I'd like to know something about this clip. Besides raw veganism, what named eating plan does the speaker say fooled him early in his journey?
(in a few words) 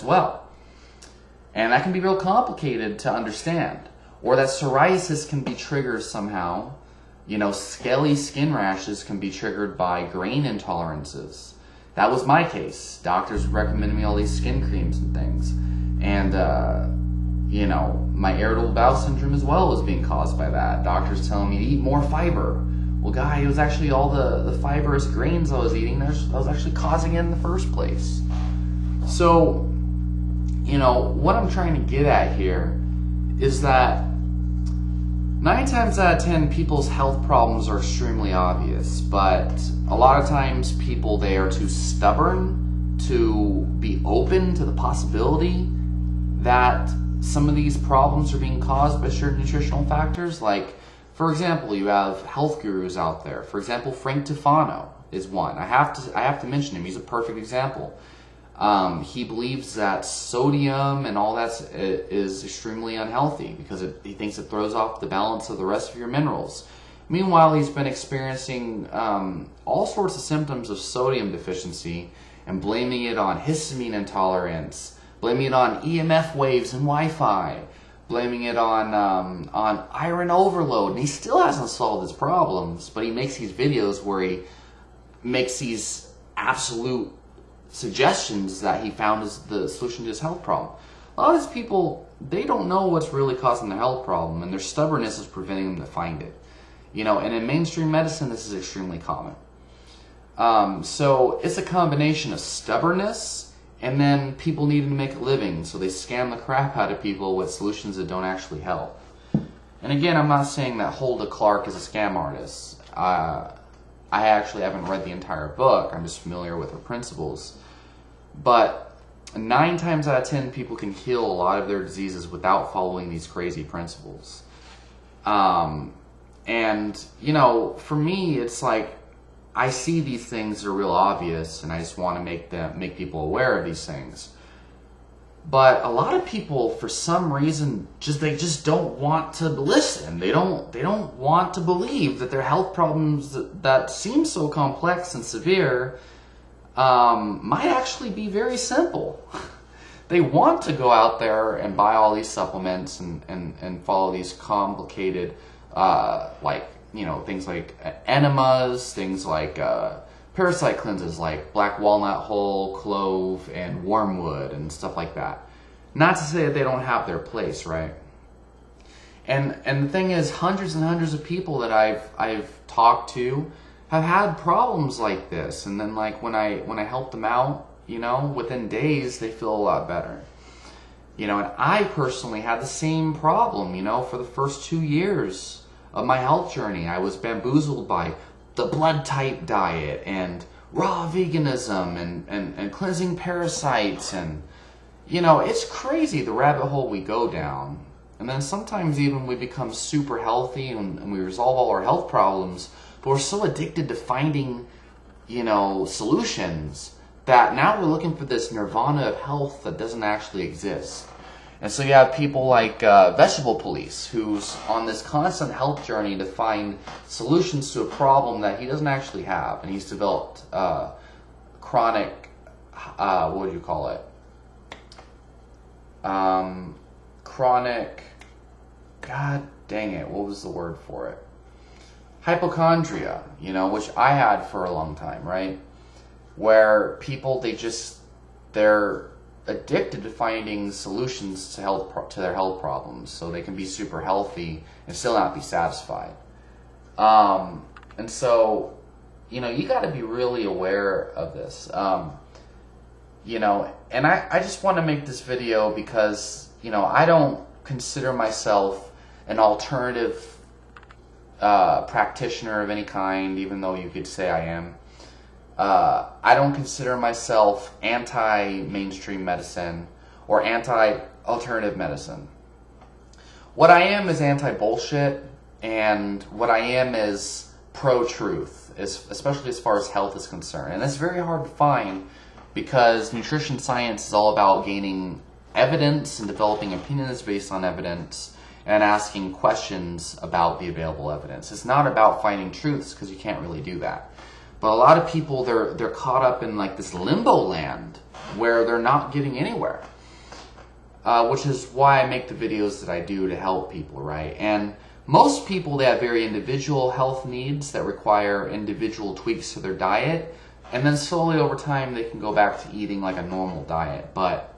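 blood type diet.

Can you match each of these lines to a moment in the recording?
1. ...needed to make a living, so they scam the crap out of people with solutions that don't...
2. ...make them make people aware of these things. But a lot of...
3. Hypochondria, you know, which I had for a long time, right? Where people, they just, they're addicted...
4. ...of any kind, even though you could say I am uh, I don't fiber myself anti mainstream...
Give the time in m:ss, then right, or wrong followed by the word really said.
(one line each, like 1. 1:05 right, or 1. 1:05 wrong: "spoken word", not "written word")
1. 1:44 right
2. 2:12 right
3. 3:52 right
4. 4:22 wrong: "consider", not "fiber".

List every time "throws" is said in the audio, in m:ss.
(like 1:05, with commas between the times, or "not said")
1:04.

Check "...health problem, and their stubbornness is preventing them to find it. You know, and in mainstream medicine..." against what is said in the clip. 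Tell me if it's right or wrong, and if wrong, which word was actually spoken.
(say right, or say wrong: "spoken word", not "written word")
right.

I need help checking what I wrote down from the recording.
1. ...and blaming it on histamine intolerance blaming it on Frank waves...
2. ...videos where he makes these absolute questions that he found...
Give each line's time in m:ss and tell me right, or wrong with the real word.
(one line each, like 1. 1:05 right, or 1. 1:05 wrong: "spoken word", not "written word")
1. 1:12 wrong: "EMF", not "Frank"
2. 1:23 wrong: "suggestions", not "questions".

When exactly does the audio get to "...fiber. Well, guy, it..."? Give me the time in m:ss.
0:22.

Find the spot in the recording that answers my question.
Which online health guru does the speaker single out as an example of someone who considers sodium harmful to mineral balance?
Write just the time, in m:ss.
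0:53.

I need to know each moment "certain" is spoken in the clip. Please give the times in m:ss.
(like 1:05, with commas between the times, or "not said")
0:49.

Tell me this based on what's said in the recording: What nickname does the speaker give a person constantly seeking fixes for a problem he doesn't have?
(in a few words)
Vegetable Police.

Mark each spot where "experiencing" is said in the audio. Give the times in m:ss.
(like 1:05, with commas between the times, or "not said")
1:07.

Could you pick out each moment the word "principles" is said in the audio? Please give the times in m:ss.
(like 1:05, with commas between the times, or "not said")
1:56, 2:03.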